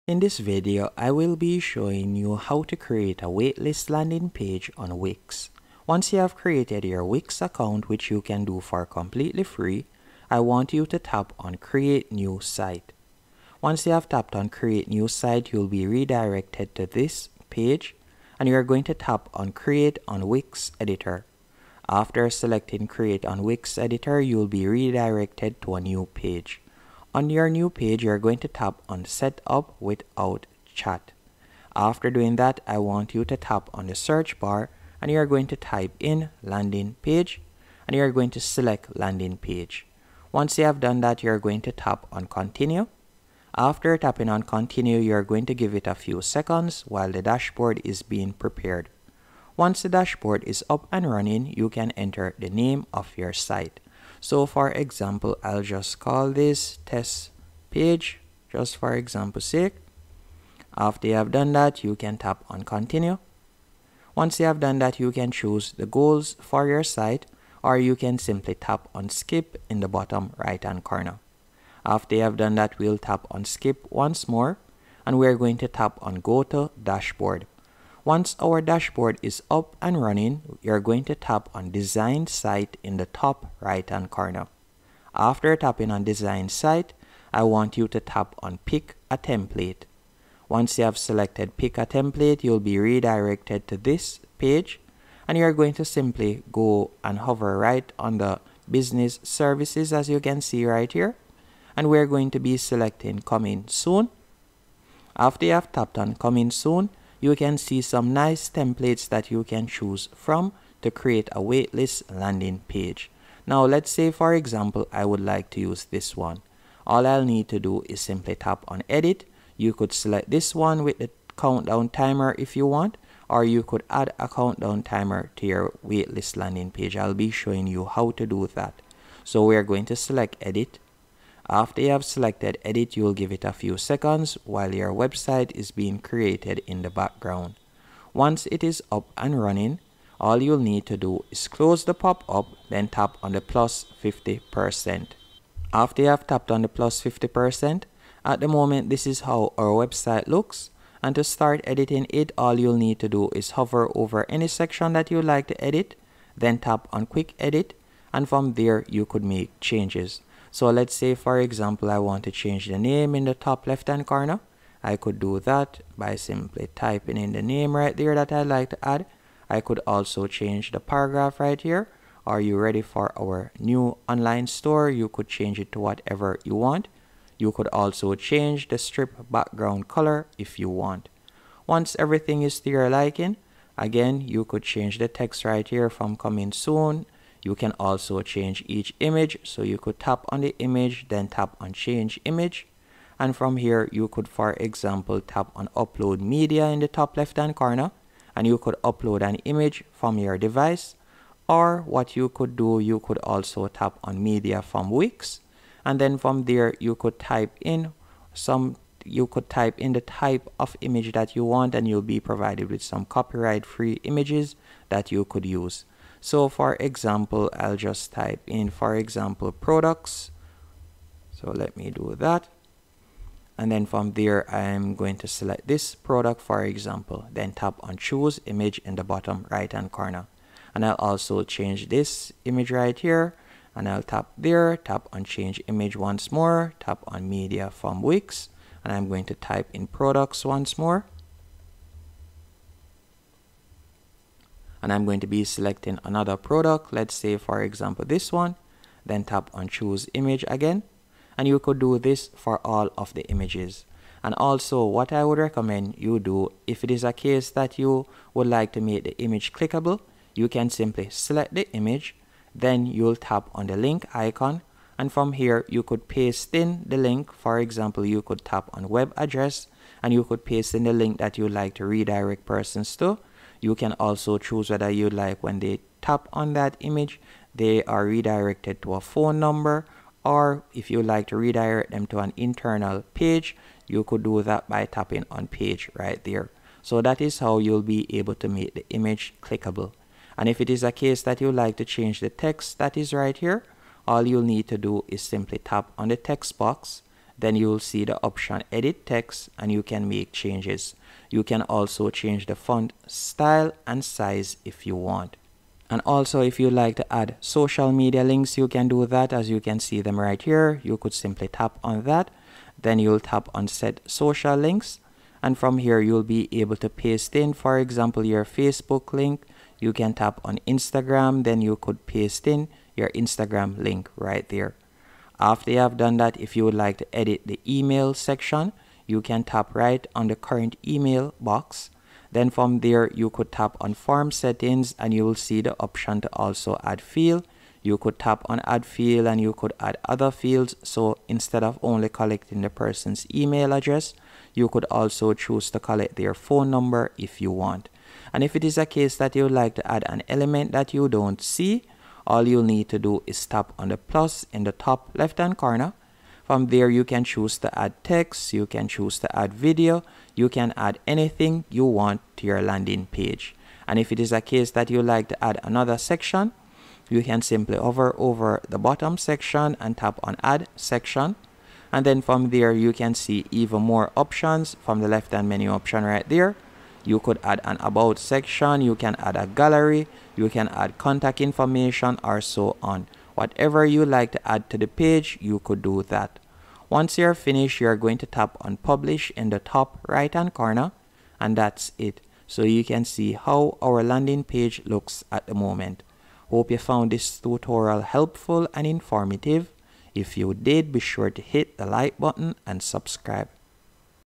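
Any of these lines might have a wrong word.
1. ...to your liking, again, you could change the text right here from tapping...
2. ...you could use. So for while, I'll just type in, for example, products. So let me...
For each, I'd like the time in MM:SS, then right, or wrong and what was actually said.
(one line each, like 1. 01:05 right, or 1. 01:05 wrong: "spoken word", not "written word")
1. 03:02 wrong: "coming", not "tapping"
2. 03:35 wrong: "example", not "while".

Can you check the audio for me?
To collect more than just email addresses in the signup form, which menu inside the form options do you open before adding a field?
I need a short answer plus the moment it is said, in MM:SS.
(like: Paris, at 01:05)
form settings, at 05:33.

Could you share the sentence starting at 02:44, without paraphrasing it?
I could do that by simply typing in the name right there that I'd like to add.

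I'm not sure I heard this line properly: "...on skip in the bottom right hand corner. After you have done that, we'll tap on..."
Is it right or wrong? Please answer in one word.
right.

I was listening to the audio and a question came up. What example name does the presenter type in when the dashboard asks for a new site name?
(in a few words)
test page.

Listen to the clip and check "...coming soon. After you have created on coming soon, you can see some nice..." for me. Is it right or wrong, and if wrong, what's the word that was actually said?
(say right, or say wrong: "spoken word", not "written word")
wrong: "tapped", not "created".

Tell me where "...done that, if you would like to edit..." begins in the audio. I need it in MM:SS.
05:25.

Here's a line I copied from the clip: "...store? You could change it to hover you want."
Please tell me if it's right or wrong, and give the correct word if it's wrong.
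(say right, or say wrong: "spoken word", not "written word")
wrong: "whatever", not "hover".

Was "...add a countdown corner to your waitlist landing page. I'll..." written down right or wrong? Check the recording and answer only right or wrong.
wrong.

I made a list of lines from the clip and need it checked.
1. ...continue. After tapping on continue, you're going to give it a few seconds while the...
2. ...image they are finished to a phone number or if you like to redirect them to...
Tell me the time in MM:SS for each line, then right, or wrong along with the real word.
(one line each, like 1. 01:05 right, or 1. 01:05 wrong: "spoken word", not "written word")
1. 00:42 right
2. 04:36 wrong: "redirected", not "finished".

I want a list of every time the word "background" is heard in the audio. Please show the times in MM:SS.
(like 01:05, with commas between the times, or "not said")
02:16, 02:59.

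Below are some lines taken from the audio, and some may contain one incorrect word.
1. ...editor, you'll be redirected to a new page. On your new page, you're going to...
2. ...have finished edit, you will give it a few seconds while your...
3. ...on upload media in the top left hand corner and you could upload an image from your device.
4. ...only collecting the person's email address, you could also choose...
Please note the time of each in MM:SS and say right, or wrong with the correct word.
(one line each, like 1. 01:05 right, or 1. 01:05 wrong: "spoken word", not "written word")
1. 00:23 right
2. 02:11 wrong: "selected", not "finished"
3. 03:15 right
4. 05:41 right.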